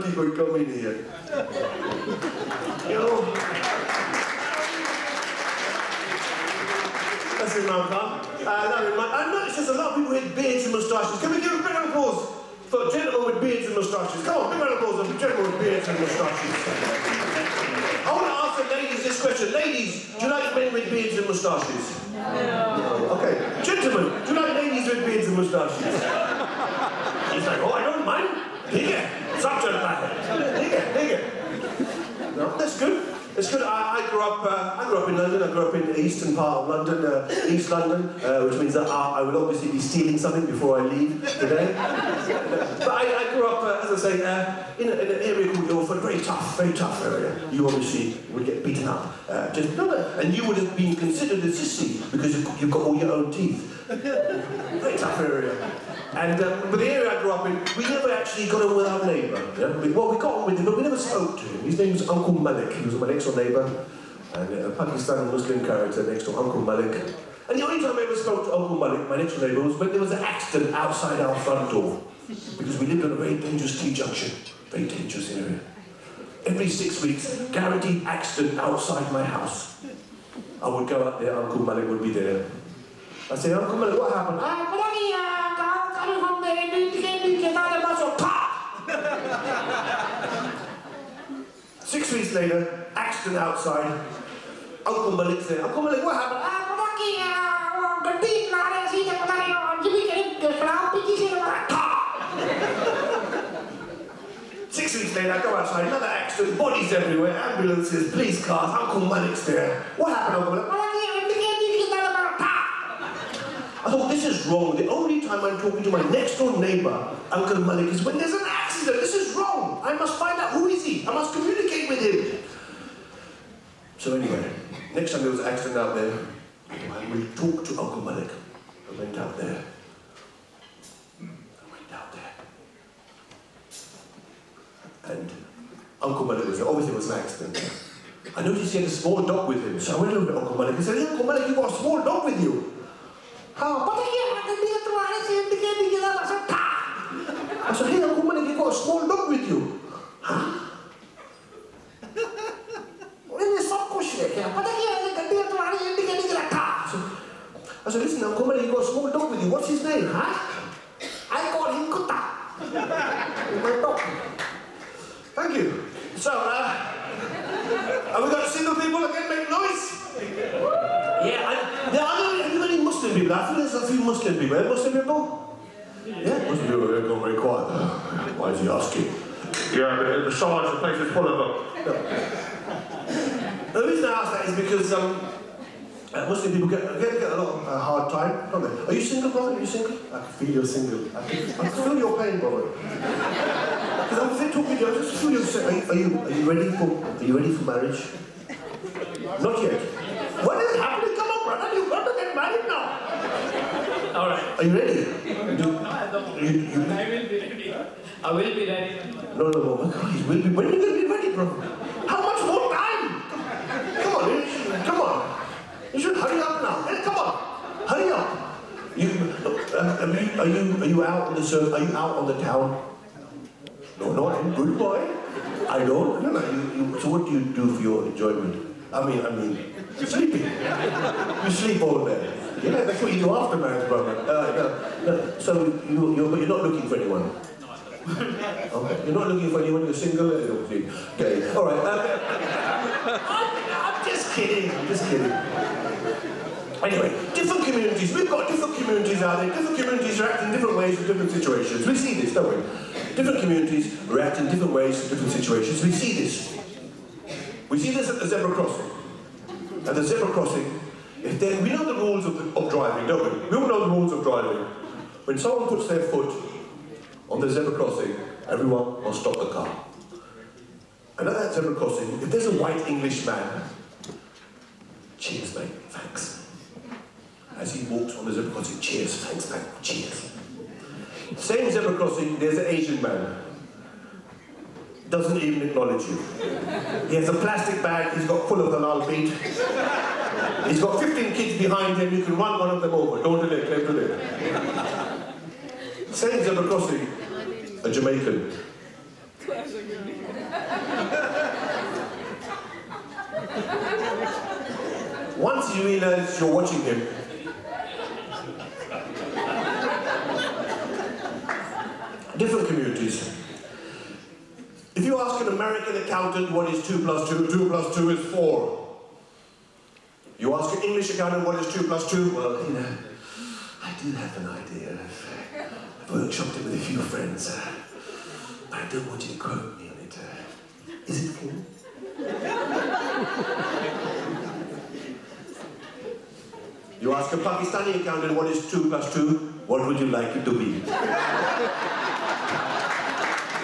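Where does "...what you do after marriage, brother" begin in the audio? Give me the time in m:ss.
3:53.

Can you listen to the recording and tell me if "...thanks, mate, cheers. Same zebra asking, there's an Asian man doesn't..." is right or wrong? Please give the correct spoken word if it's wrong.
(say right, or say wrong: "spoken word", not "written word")
wrong: "crossing", not "asking".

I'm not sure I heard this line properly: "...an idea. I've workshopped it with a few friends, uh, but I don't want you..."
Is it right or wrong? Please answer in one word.
right.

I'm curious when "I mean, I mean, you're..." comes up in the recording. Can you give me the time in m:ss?
3:48.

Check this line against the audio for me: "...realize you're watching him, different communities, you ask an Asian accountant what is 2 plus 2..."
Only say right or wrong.
wrong.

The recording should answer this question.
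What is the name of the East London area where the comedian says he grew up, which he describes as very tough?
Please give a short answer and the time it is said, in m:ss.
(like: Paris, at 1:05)
Ilford, at 0:45.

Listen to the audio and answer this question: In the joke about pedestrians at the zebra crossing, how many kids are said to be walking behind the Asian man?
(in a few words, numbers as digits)
15.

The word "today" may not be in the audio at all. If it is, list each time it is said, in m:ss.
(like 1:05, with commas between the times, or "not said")
0:41.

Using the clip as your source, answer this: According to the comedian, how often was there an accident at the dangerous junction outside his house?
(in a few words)
Every six weeks.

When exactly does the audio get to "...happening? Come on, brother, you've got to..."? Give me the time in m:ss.
3:20.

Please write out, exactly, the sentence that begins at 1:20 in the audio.
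I would go out there, Uncle Malik would be there.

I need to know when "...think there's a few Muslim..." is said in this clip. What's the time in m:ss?
2:53.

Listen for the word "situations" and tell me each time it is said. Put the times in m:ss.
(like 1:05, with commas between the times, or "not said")
4:11, 4:15.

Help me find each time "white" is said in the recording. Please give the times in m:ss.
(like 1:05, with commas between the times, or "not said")
4:32.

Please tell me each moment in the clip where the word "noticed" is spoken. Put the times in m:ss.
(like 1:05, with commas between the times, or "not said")
0:09, 2:18.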